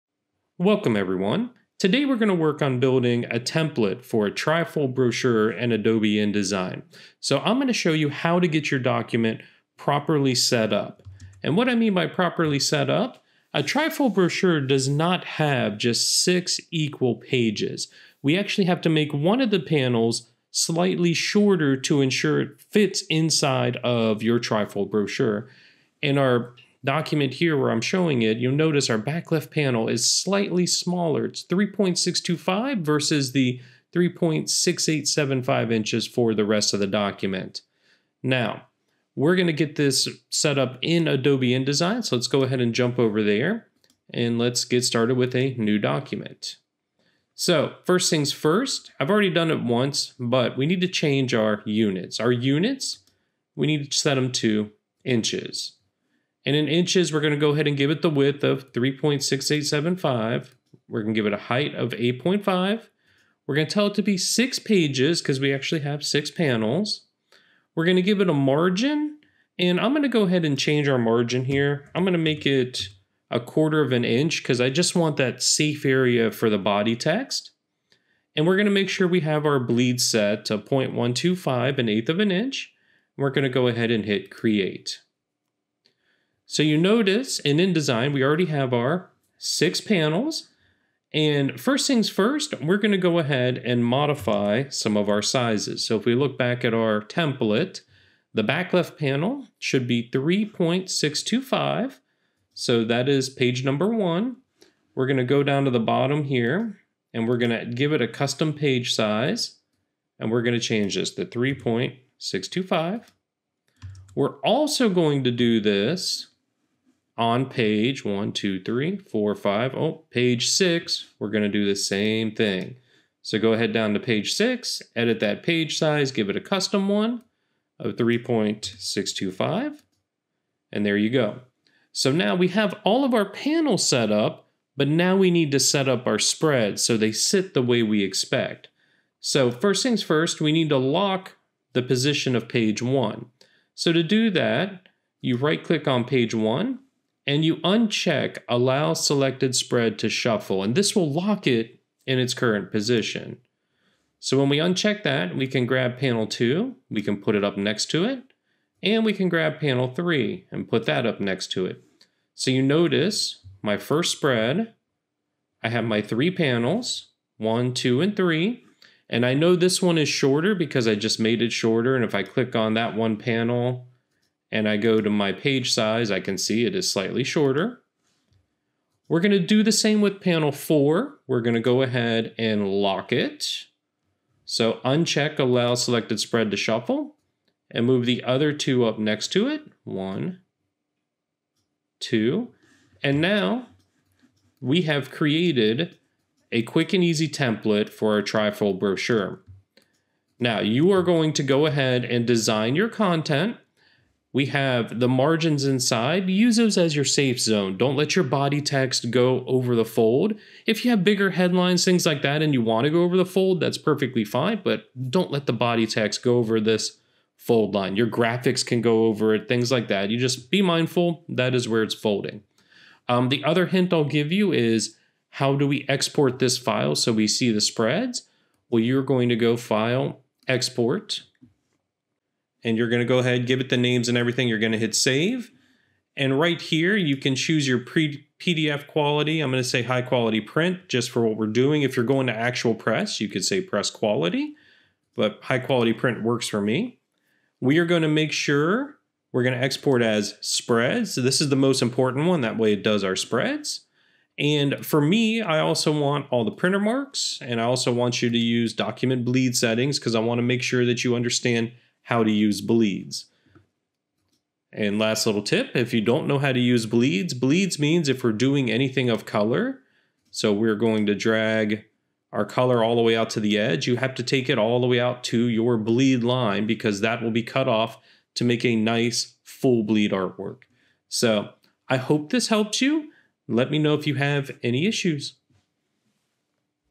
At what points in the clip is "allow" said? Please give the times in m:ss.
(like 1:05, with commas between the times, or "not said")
2:28, 3:05.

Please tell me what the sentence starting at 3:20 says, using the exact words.
Now you are going to go ahead and design your content we have the margins inside.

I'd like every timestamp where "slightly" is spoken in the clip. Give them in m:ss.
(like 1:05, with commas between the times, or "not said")
0:20, 0:30, 2:56.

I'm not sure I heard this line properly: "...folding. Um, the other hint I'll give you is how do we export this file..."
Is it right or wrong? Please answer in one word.
right.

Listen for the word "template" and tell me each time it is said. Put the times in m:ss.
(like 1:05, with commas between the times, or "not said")
0:03, 1:37, 3:17.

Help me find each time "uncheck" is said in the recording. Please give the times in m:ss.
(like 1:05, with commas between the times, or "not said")
2:27, 2:34, 3:04.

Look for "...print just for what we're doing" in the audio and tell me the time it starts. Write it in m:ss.
4:00.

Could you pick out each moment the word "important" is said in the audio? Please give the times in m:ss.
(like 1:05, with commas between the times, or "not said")
4:11.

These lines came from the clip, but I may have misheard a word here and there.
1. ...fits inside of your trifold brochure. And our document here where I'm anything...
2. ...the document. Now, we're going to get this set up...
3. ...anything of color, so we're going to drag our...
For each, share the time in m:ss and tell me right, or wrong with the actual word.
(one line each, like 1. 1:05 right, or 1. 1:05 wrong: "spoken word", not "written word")
1. 0:22 wrong: "showing", not "anything"
2. 0:36 right
3. 4:28 right.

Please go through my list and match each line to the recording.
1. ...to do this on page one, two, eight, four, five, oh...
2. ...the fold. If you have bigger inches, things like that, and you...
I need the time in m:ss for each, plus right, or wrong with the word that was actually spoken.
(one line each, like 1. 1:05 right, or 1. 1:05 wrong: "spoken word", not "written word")
1. 1:55 wrong: "three", not "eight"
2. 3:29 wrong: "headlines", not "inches".